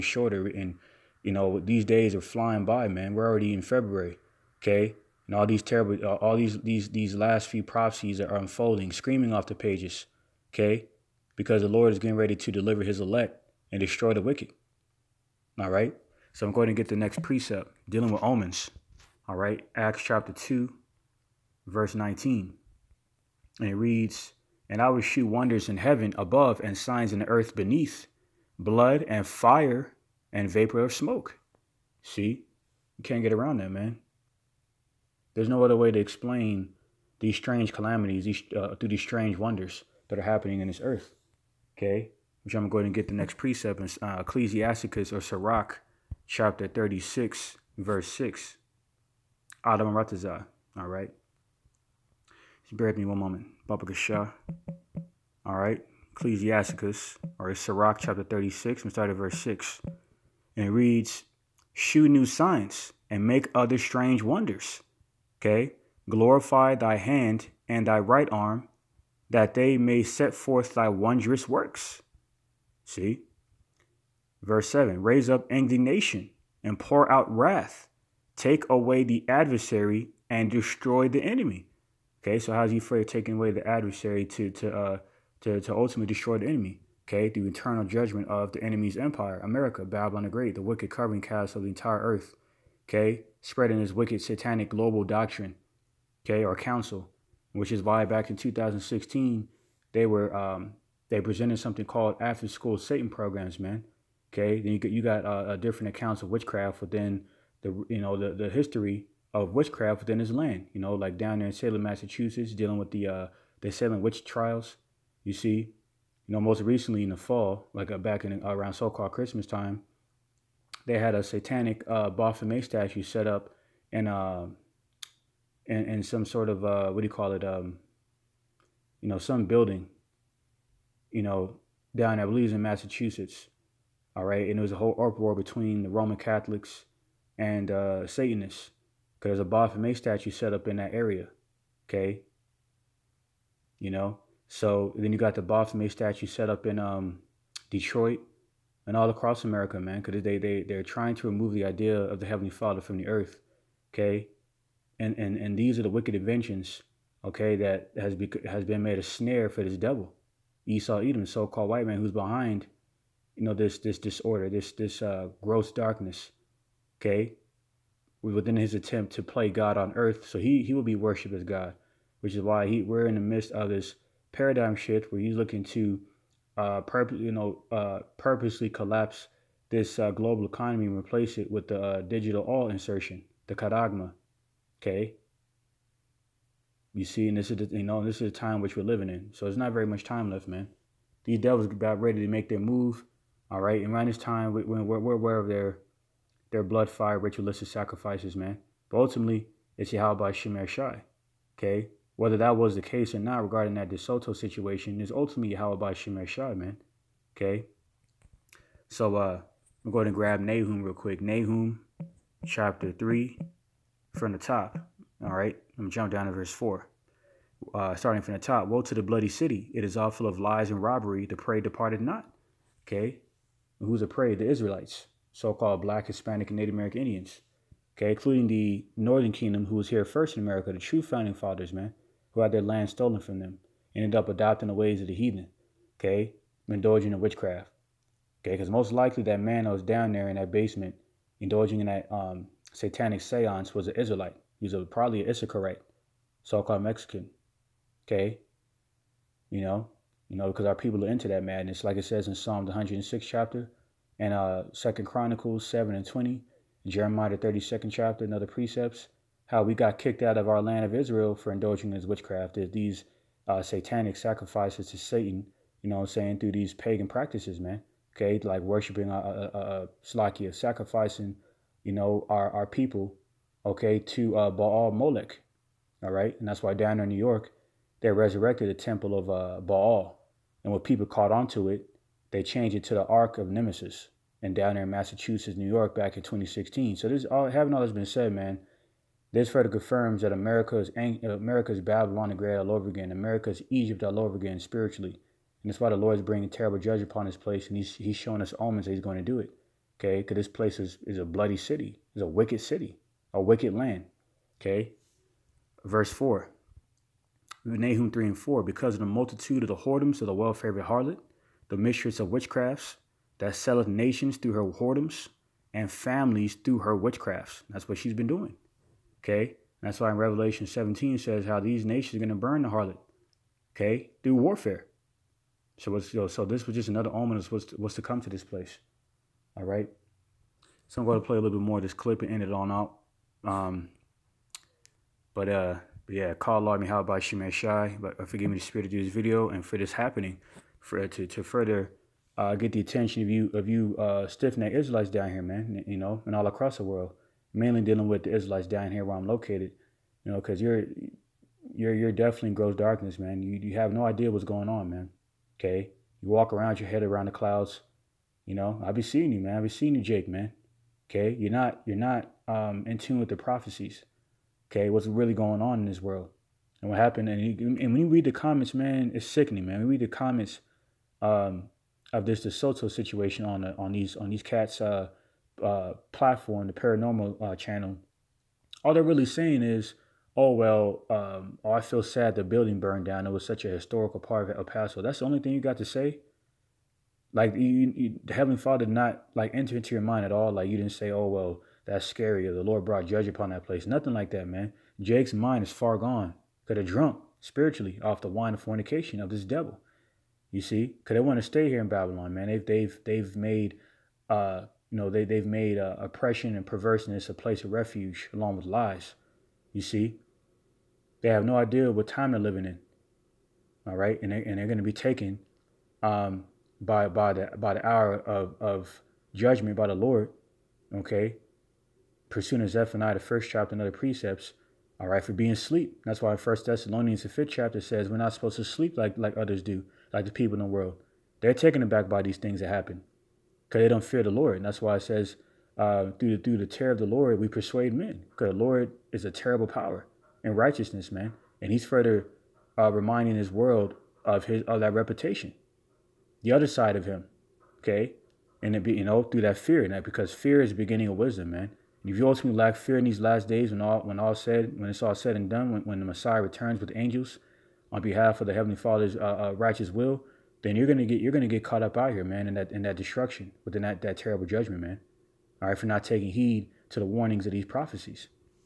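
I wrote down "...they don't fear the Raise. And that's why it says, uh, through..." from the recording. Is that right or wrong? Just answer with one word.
wrong.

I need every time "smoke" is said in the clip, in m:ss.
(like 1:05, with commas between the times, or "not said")
0:30.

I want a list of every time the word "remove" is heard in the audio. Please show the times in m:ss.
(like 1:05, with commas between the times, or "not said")
2:31.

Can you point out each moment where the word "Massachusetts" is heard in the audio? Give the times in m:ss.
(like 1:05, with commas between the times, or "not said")
1:51, 2:12, 4:44.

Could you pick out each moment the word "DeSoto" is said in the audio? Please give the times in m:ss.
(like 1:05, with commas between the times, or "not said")
3:23, 6:12.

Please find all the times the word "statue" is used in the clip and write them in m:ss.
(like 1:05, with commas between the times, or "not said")
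2:02, 2:19, 2:25.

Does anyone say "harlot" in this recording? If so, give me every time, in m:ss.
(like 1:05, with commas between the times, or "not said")
5:10, 5:22.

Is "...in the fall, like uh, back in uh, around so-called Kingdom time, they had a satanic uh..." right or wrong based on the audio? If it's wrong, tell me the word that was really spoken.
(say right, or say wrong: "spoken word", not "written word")
wrong: "Christmas", not "Kingdom".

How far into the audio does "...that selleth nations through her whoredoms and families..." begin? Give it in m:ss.
5:13.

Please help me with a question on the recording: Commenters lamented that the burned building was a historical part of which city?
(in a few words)
El Paso.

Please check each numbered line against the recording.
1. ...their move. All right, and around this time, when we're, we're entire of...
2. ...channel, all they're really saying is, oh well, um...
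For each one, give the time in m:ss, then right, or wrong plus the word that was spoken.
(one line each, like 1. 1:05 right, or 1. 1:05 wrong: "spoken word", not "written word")
1. 3:12 wrong: "aware", not "entire"
2. 6:17 right.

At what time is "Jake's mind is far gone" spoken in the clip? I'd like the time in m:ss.
6:34.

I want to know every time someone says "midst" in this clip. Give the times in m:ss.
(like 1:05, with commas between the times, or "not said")
2:53.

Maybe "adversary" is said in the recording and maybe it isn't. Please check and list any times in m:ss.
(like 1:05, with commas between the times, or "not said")
1:19, 1:23.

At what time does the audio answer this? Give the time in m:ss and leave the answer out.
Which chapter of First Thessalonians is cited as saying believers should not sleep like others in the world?
7:07.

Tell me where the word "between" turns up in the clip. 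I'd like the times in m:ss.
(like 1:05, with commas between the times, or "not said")
2:15.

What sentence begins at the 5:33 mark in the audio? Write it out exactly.
Um, but, uh, but yeah, call Lord me how about may shy?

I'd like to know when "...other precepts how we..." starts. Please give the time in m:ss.
4:18.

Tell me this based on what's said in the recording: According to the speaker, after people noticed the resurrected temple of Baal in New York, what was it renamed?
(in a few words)
Ark of Nemesis.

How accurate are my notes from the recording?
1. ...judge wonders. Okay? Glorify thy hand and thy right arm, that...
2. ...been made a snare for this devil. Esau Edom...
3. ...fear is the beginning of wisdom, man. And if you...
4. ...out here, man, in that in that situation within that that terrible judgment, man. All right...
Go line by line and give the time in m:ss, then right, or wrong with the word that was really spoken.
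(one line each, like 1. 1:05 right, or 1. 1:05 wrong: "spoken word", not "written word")
1. 1:03 wrong: "strange", not "judge"
2. 2:38 right
3. 7:30 right
4. 7:41 wrong: "destruction", not "situation".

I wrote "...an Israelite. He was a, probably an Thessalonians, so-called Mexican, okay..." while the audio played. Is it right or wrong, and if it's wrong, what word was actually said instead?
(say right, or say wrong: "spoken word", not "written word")
wrong: "Issacharite", not "Thessalonians".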